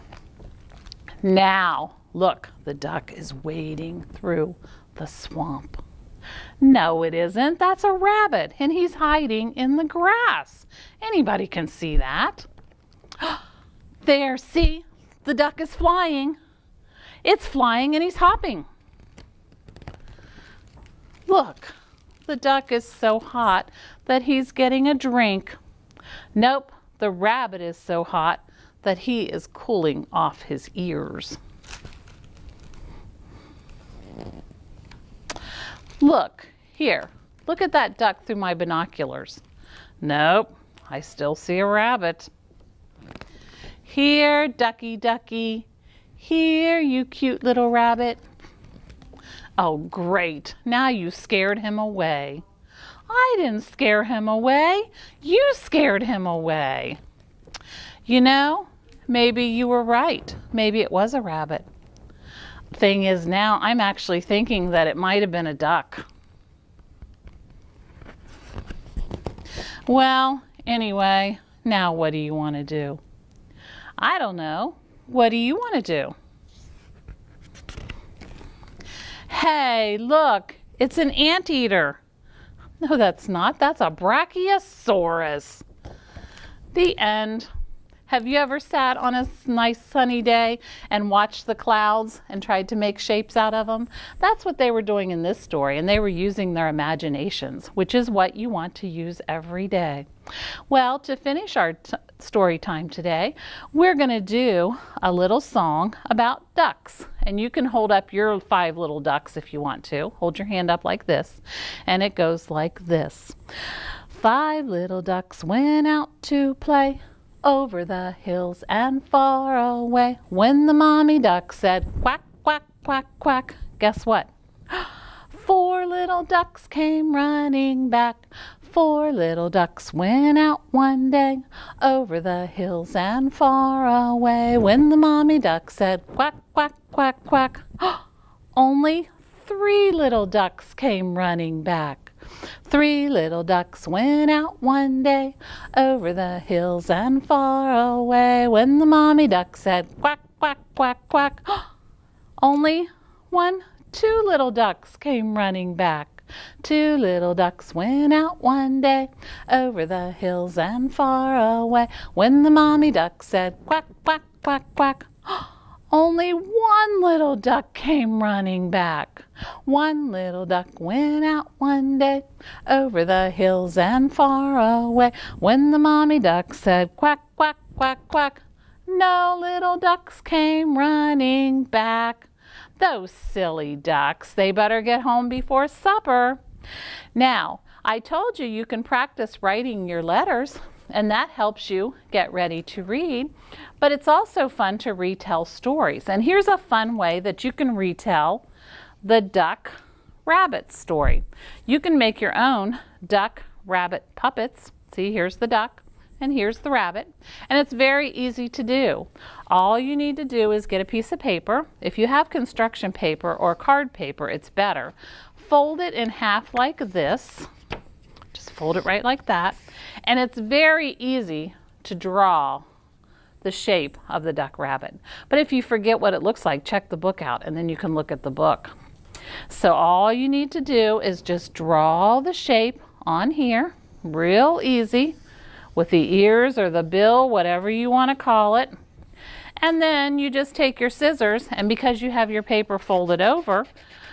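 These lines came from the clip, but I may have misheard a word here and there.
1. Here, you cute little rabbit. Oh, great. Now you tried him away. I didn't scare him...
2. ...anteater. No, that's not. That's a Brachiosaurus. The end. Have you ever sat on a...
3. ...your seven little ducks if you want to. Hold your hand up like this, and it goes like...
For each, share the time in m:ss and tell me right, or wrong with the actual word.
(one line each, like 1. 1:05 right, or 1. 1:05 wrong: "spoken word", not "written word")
1. 0:46 wrong: "scared", not "tried"
2. 1:21 right
3. 1:48 wrong: "five", not "seven".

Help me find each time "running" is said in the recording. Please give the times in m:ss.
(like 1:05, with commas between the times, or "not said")
2:07, 2:21, 2:35, 2:48, 3:00.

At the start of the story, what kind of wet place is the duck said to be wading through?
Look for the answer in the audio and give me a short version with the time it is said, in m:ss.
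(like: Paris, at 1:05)
swamp, at 0:05.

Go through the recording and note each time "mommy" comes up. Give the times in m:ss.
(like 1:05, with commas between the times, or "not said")
2:00, 2:14, 2:28, 2:42, 2:55.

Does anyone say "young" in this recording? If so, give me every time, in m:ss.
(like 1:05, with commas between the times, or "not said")
not said.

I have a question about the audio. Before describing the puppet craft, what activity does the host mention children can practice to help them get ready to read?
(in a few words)
writing your letters.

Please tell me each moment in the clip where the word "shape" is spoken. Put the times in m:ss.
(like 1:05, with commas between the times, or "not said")
1:32, 3:43, 3:52.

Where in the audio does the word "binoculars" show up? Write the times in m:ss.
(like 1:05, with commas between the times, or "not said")
0:38.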